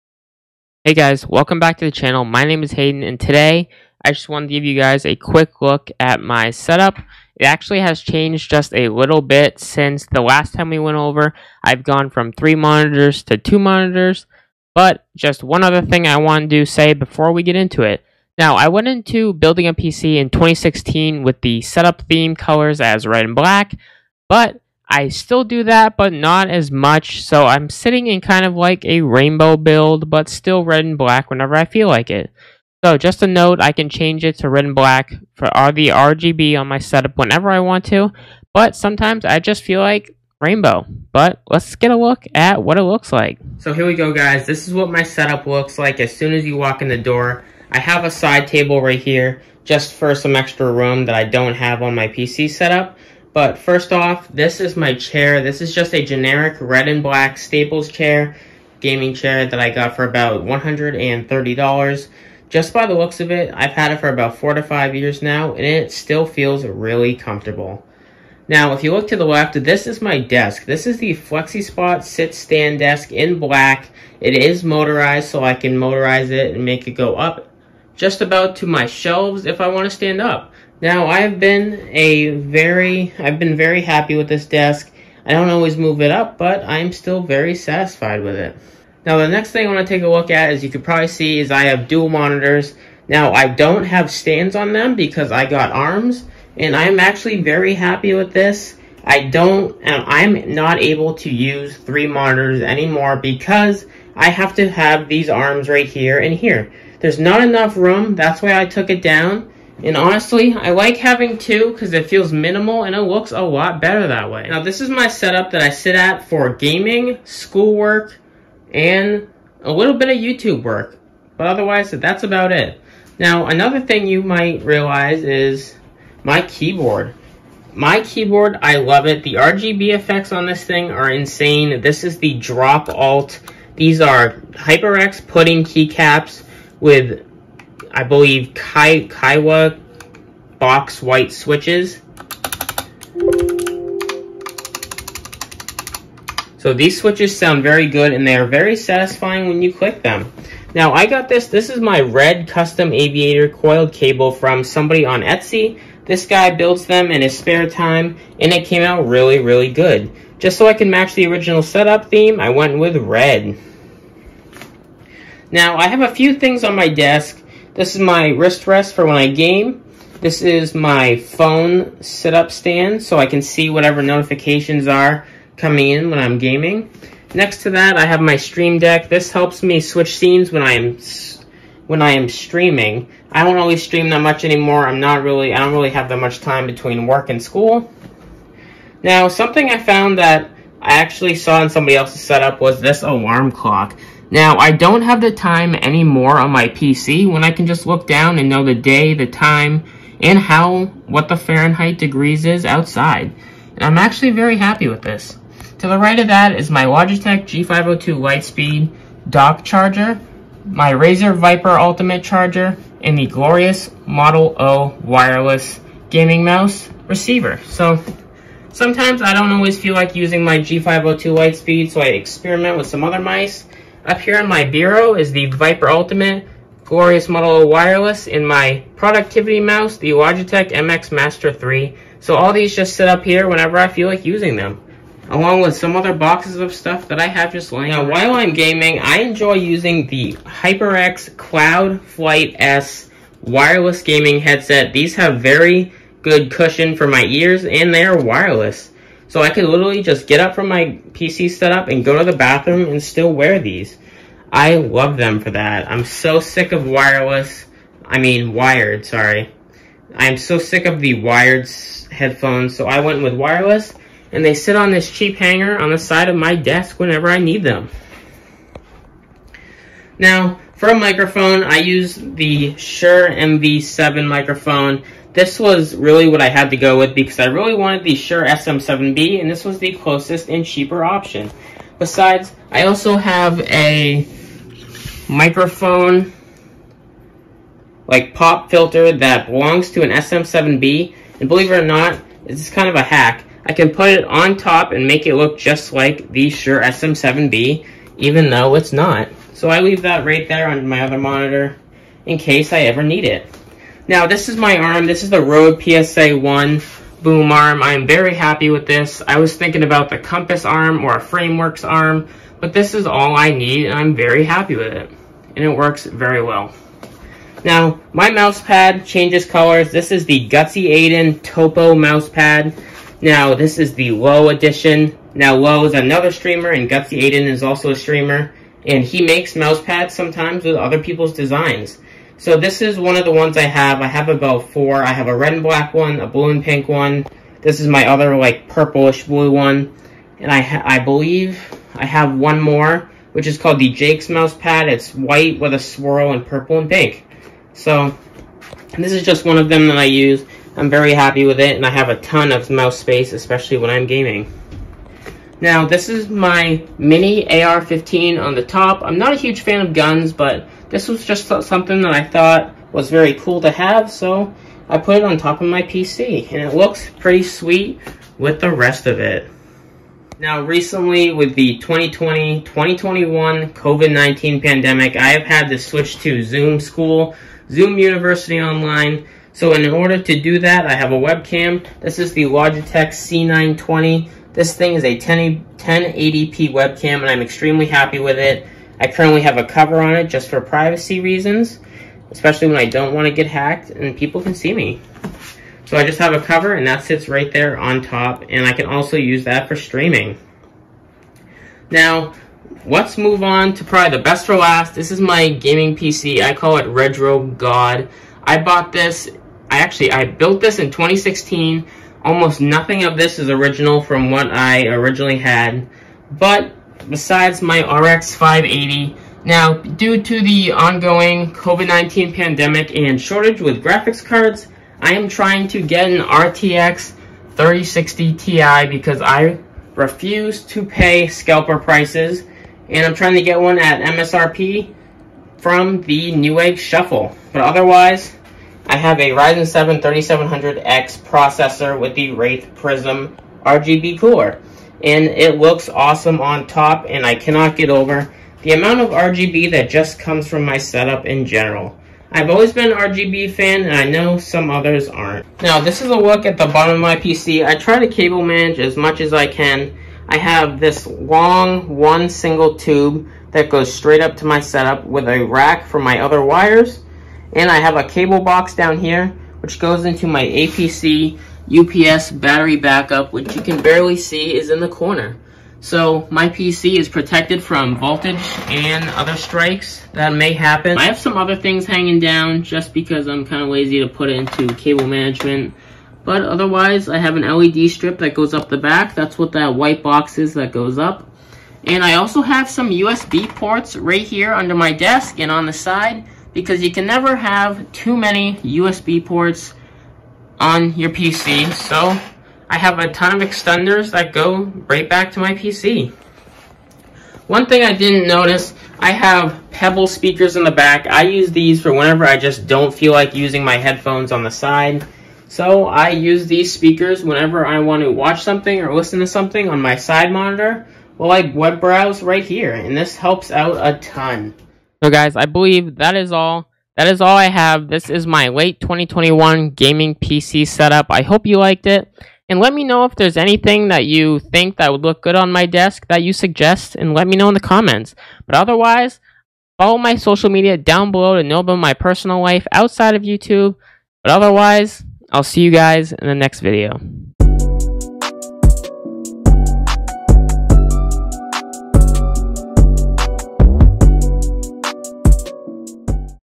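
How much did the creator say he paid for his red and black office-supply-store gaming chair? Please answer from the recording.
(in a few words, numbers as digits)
$130.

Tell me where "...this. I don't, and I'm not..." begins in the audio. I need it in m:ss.
1:38.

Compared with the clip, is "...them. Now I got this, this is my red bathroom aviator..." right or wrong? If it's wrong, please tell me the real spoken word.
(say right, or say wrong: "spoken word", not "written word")
wrong: "custom", not "bathroom".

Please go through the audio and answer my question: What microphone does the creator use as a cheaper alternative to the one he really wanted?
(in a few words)
Shure MV7.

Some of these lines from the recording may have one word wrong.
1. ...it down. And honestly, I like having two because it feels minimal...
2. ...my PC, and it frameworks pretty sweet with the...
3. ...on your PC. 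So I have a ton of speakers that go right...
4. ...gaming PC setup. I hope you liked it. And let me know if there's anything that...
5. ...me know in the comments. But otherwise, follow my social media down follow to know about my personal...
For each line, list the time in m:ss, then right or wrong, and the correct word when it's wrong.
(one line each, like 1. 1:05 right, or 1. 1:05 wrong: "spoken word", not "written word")
1. 1:48 right
2. 6:05 wrong: "looks", not "frameworks"
3. 8:20 wrong: "extenders", not "speakers"
4. 8:49 right
5. 8:57 wrong: "below", not "follow".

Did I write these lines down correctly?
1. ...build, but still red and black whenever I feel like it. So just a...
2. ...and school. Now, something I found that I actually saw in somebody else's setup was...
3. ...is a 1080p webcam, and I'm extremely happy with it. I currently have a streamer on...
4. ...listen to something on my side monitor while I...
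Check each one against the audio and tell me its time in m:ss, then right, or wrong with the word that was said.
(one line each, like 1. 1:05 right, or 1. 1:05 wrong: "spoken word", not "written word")
1. 0:29 right
2. 3:07 right
3. 6:24 wrong: "cover", not "streamer"
4. 8:38 right.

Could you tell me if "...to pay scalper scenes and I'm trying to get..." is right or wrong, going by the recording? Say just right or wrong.
wrong.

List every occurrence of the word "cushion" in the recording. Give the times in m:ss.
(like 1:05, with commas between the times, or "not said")
4:06.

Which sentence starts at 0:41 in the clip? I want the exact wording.
But let's get a look at what it looks like.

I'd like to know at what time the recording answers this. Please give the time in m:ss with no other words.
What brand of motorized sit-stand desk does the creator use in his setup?
1:11.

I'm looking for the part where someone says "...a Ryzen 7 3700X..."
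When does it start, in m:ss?
7:19.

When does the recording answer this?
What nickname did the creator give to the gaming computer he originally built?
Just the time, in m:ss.
6:46.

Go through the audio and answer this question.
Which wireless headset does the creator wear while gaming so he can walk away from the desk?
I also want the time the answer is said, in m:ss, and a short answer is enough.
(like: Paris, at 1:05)
HyperX Cloud Flight S, at 4:00.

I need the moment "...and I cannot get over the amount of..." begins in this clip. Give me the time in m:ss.
7:27.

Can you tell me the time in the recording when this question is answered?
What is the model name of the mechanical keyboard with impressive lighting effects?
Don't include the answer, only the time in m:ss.
2:12.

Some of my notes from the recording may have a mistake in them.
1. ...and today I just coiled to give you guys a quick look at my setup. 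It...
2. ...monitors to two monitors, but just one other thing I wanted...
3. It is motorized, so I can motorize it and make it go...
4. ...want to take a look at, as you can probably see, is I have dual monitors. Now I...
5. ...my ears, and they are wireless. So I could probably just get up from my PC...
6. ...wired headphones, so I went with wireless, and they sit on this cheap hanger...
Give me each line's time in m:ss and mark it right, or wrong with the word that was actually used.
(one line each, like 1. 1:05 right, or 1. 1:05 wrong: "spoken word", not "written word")
1. 0:03 wrong: "wanted", not "coiled"
2. 0:12 right
3. 1:14 right
4. 1:29 right
5. 4:07 wrong: "literally", not "probably"
6. 4:21 right.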